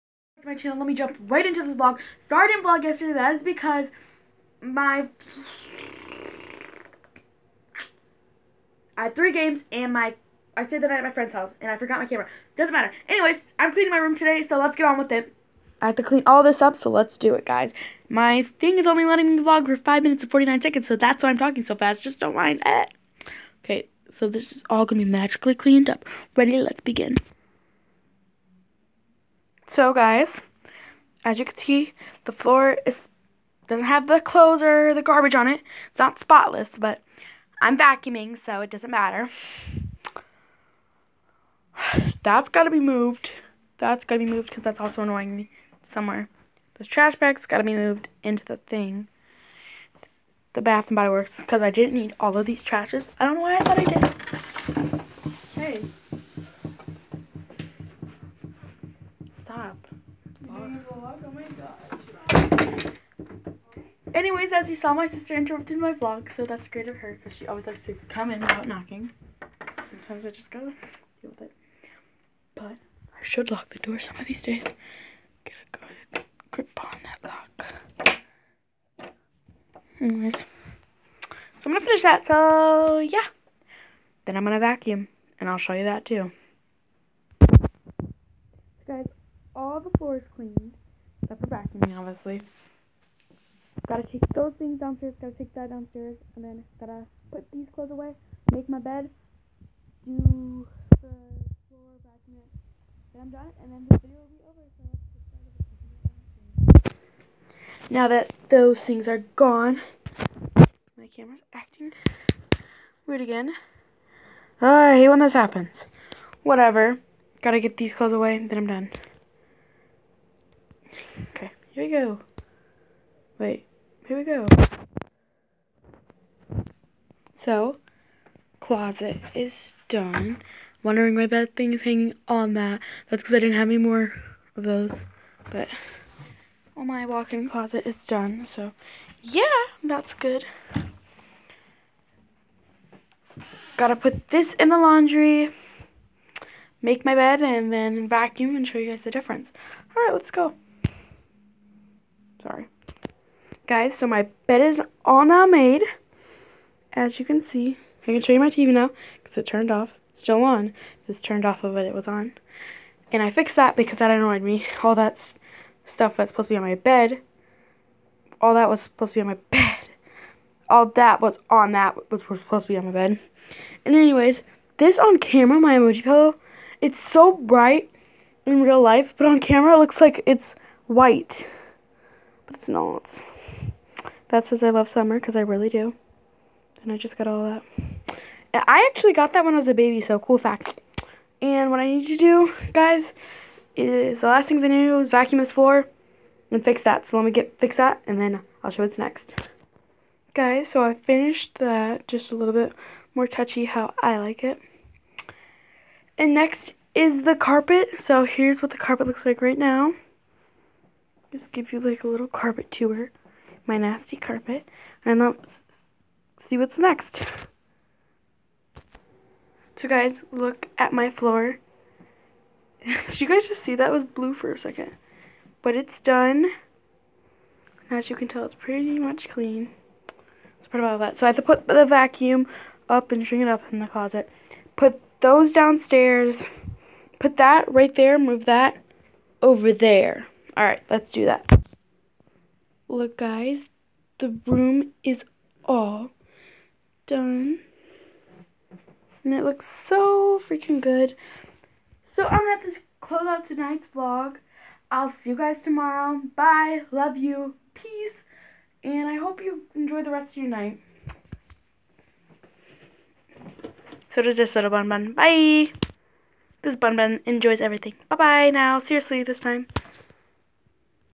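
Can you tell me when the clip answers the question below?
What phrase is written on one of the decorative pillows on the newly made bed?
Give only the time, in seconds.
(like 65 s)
184 s.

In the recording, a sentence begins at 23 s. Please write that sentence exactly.
Okay, so this is all going to be magically cleaned up.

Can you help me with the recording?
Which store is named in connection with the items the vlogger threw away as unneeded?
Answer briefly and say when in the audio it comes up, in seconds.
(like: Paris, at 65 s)
Bath and Body Works, at 50 s.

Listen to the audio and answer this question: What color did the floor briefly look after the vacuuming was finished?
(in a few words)
Blue.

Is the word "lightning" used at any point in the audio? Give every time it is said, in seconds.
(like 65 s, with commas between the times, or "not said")
not said.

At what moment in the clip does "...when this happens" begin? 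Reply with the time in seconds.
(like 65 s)
115 s.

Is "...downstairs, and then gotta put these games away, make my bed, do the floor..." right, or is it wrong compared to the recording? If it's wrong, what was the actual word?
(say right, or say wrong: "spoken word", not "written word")
wrong: "clothes", not "games".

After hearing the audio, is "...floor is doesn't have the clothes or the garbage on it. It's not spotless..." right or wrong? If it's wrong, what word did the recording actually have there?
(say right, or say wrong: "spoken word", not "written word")
right.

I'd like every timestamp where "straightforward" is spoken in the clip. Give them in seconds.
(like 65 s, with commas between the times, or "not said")
not said.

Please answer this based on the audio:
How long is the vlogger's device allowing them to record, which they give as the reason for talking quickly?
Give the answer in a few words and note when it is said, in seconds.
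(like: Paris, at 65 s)
5 minutes and 49 seconds, at 19 s.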